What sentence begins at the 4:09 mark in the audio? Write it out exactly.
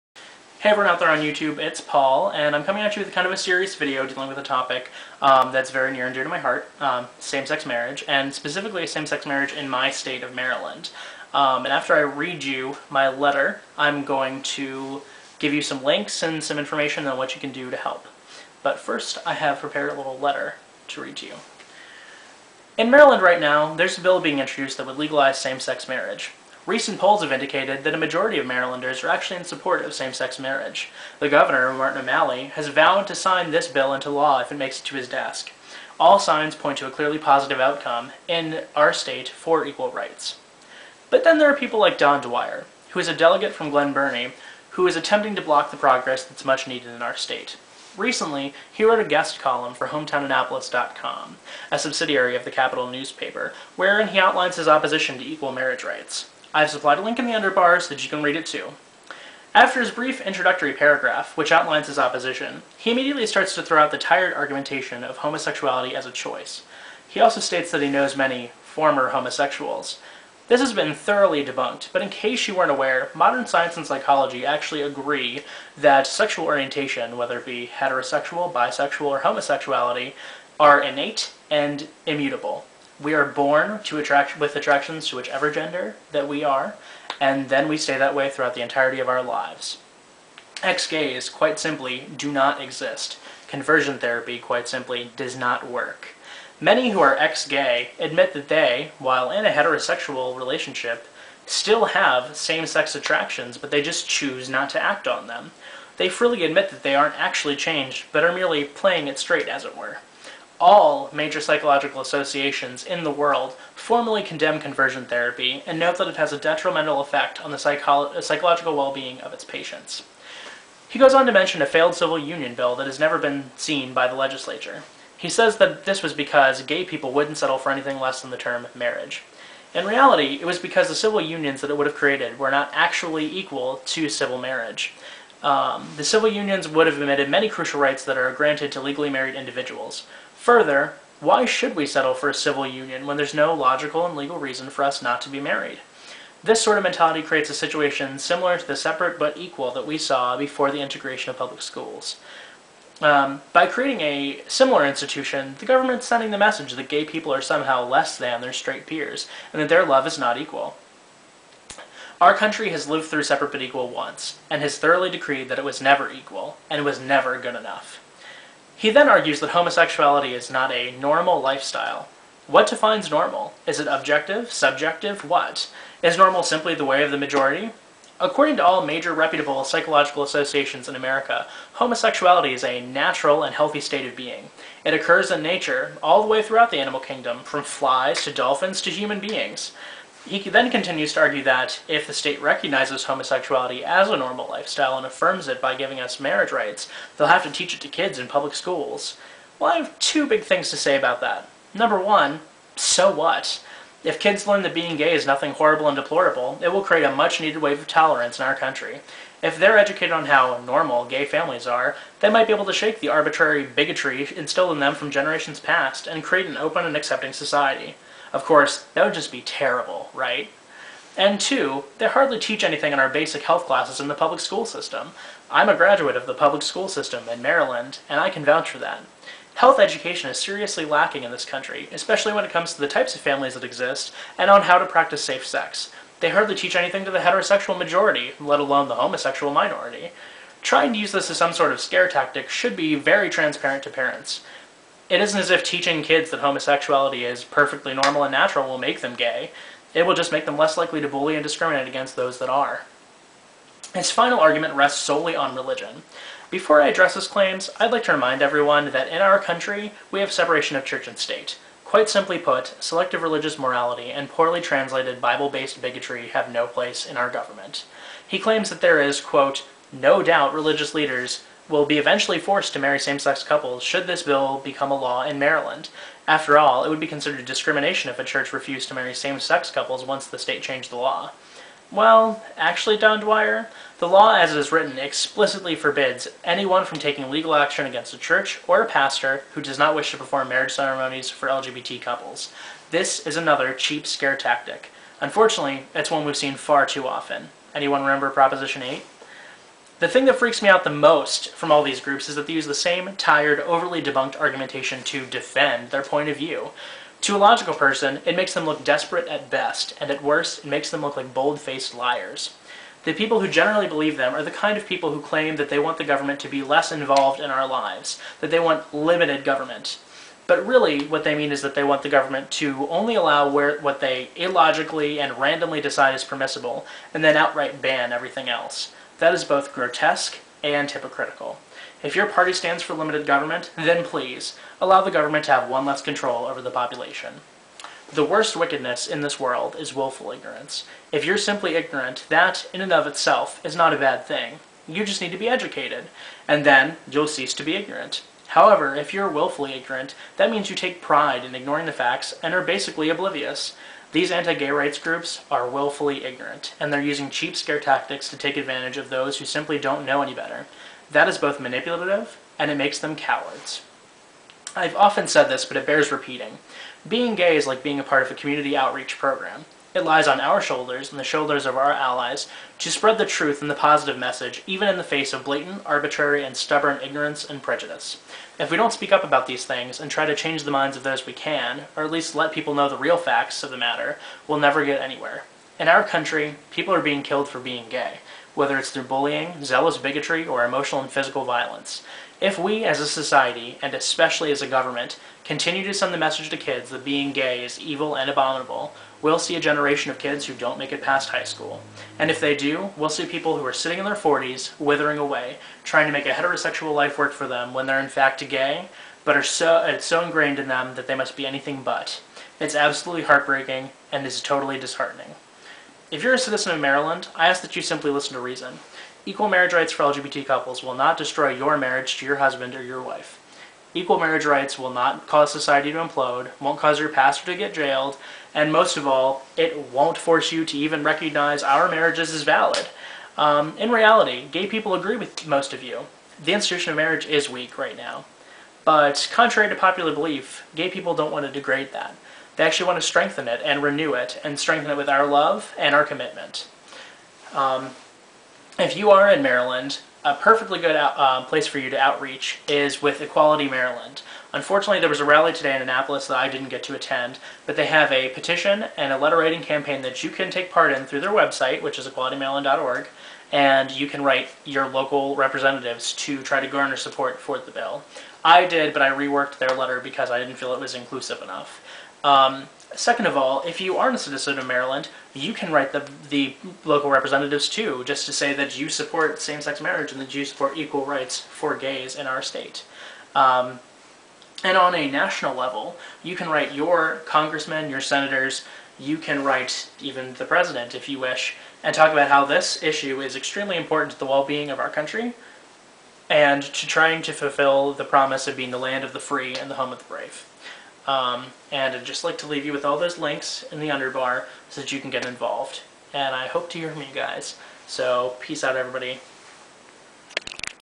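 It will just make them less likely to bully and discriminate against those that are.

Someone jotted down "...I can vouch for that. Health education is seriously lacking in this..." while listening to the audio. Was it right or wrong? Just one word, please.
right.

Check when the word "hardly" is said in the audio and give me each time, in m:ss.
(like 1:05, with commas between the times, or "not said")
3:42, 3:56.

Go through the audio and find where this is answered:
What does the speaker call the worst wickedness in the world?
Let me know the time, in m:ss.
5:39.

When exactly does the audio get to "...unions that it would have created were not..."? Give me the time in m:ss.
2:11.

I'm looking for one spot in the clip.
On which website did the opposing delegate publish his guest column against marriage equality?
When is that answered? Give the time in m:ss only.
0:49.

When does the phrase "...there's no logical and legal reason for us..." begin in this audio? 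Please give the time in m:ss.
2:23.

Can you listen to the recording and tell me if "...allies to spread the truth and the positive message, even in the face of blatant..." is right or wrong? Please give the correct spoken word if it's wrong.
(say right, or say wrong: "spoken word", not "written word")
right.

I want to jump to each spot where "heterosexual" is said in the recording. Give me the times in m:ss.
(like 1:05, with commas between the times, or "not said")
1:17, 1:39, 3:57, 6:46.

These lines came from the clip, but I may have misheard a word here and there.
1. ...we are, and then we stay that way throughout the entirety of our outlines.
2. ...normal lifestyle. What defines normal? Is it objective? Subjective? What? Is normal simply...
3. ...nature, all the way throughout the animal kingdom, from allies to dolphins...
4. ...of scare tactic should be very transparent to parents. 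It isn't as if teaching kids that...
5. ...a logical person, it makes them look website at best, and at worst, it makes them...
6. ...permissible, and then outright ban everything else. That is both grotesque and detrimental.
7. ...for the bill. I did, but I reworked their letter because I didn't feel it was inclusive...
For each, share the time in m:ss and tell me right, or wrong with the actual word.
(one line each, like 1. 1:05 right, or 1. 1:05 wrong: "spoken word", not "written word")
1. 1:26 wrong: "lives", not "outlines"
2. 2:50 right
3. 3:05 wrong: "flies", not "allies"
4. 4:01 right
5. 5:07 wrong: "desperate", not "website"
6. 5:26 wrong: "hypocritical", not "detrimental"
7. 7:47 right.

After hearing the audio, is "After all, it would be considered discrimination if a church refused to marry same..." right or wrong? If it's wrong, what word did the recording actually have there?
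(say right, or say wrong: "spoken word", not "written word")
right.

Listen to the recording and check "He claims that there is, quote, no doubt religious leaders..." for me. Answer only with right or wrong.
right.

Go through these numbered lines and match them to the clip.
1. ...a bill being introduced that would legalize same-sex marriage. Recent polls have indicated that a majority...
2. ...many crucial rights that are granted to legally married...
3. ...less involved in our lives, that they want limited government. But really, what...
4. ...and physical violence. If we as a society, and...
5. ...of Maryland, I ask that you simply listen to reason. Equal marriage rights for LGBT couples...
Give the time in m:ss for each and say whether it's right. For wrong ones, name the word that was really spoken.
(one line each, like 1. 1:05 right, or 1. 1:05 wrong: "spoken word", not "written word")
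1. 0:23 right
2. 2:17 right
3. 5:16 right
4. 6:31 right
5. 6:56 right.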